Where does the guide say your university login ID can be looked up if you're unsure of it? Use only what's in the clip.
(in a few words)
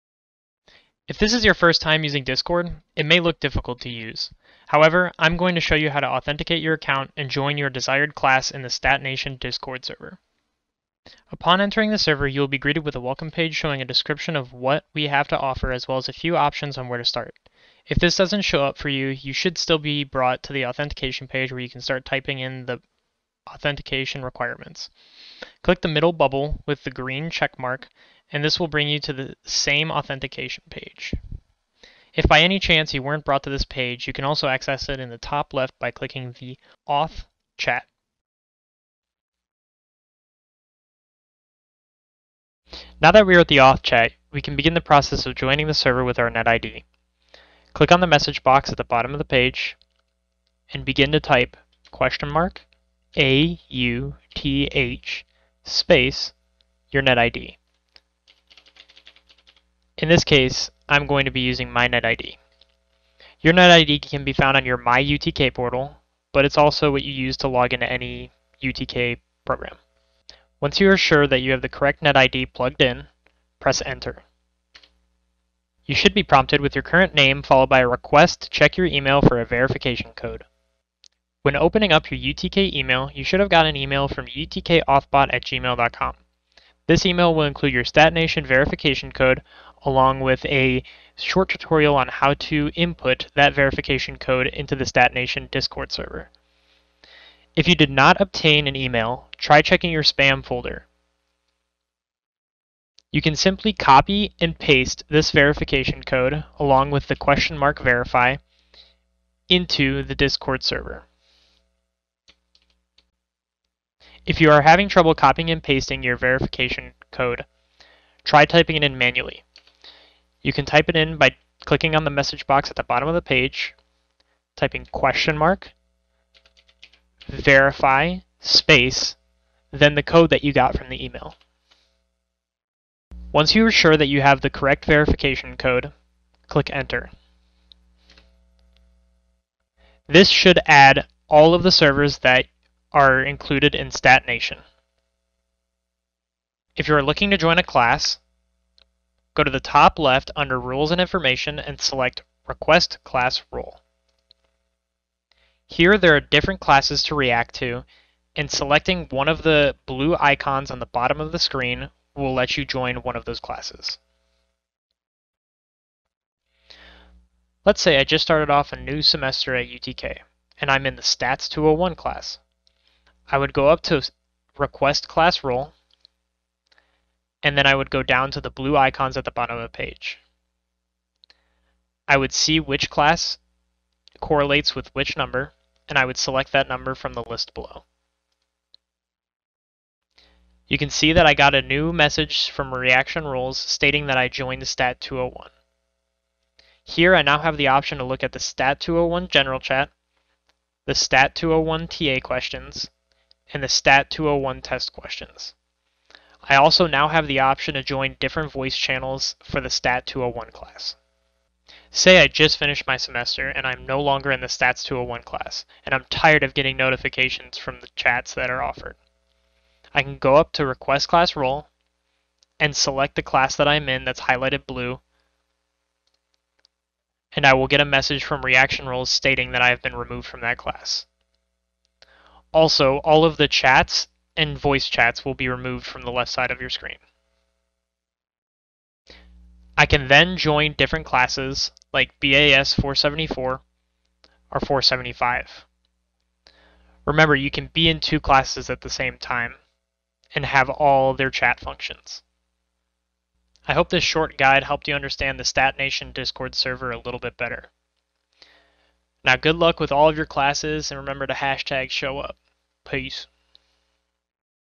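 MyUTK portal.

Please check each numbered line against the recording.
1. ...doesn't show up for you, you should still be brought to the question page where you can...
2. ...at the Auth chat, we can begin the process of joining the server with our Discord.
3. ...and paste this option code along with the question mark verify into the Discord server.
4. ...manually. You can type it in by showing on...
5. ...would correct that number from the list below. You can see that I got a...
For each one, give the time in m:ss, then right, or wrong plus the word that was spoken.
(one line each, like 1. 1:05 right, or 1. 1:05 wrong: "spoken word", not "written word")
1. 0:18 wrong: "authentication", not "question"
2. 0:43 wrong: "NetID", not "Discord"
3. 1:44 wrong: "verification", not "option"
4. 1:58 wrong: "clicking", not "showing"
5. 3:06 wrong: "select", not "correct".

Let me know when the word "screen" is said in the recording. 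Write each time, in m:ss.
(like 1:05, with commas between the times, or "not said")
2:41, 3:56.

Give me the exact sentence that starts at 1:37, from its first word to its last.
If you did not obtain an email, try checking your spam folder.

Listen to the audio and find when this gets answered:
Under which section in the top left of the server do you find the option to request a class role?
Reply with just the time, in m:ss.
2:30.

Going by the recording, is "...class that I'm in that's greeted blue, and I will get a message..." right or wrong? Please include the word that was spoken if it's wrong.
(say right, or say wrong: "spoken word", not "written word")
wrong: "highlighted", not "greeted".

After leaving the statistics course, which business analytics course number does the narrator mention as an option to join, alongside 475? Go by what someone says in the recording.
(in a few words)
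BAS 474.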